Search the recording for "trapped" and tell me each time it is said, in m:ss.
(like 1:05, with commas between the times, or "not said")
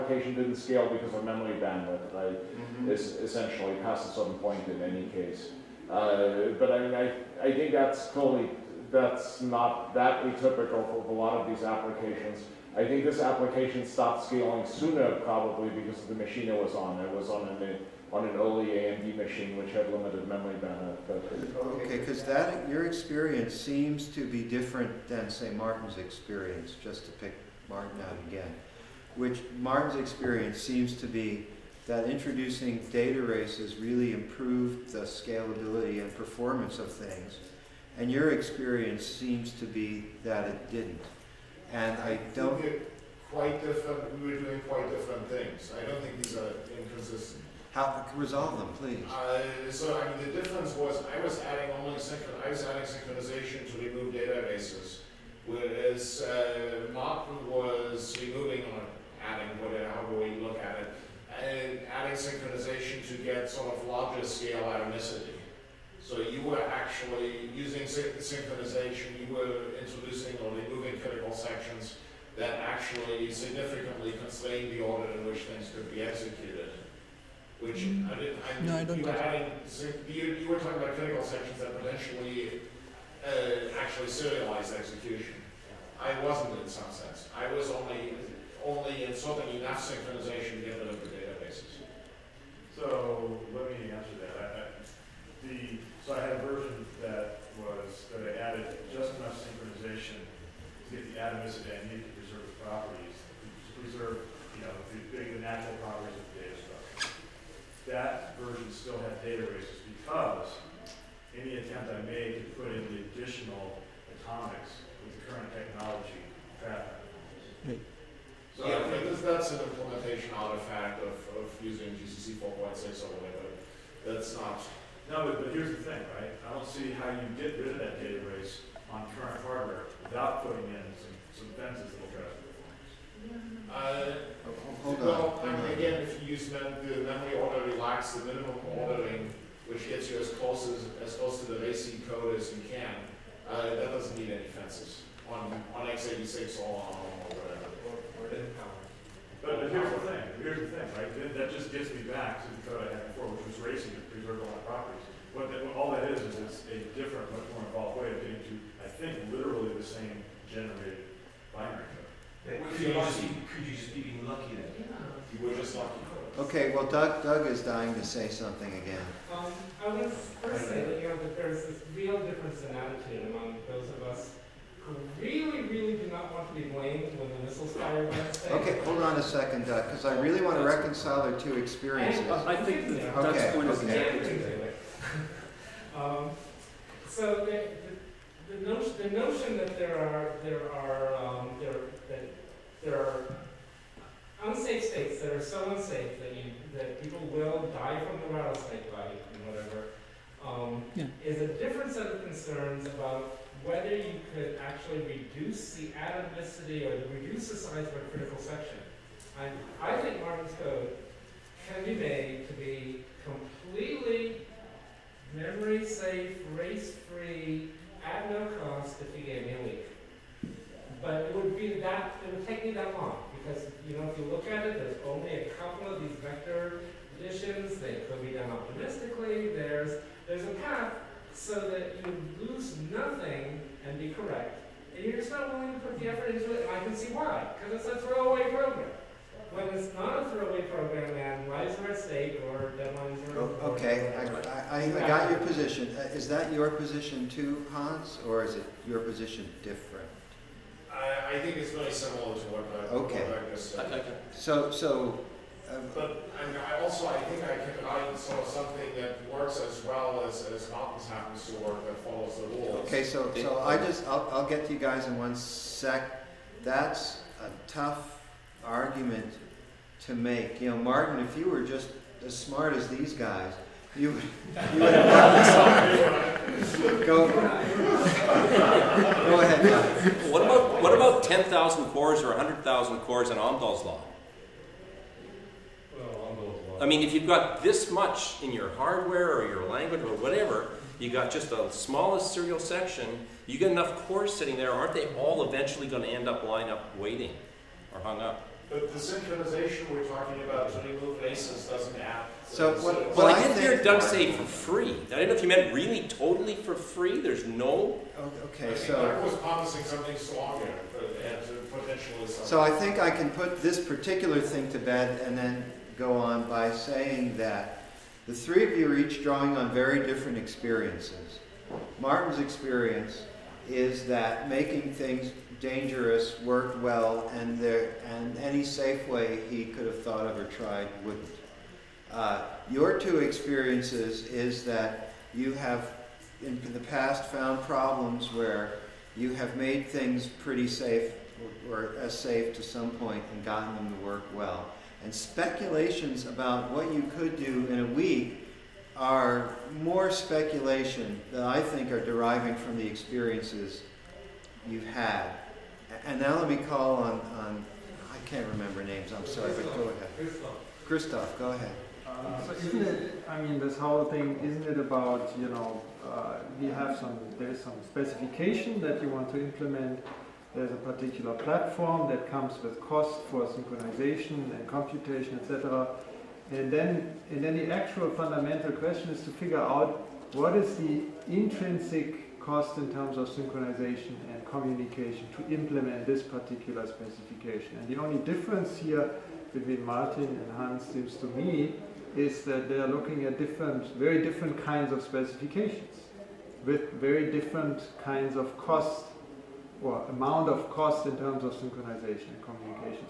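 not said.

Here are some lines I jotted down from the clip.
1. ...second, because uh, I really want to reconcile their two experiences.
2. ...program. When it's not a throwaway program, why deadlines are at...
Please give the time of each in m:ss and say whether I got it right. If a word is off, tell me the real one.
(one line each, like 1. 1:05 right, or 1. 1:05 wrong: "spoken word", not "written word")
1. 2:59 right
2. 3:58 wrong: "lives", not "deadlines".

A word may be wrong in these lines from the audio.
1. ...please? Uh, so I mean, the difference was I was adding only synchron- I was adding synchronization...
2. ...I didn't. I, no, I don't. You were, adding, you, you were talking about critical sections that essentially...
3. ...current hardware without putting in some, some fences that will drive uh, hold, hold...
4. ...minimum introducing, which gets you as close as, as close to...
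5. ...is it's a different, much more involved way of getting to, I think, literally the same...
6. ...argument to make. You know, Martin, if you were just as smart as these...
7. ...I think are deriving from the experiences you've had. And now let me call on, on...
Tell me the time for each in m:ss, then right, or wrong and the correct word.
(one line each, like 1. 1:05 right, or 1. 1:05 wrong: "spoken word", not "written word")
1. 0:48 right
2. 1:18 wrong: "potentially", not "essentially"
3. 2:09 right
4. 2:18 wrong: "ordering", not "introducing"
5. 2:36 right
6. 4:28 right
7. 5:51 right.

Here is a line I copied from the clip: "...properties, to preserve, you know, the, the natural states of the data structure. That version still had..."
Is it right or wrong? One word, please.
wrong.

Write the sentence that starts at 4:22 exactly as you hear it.
Okay, so so I just I'll, I'll get to you guys in one sec.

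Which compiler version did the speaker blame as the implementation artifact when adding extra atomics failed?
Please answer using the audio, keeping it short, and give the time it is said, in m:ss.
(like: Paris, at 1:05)
GCC 4.6, at 2:01.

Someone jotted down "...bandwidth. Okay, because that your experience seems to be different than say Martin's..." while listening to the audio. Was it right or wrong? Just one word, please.
right.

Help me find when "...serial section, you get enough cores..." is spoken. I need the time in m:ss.
4:52.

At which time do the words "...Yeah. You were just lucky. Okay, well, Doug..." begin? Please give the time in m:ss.
2:44.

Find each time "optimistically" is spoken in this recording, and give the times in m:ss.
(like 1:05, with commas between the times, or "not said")
3:48.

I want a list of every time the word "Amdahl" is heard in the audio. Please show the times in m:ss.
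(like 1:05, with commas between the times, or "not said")
4:43.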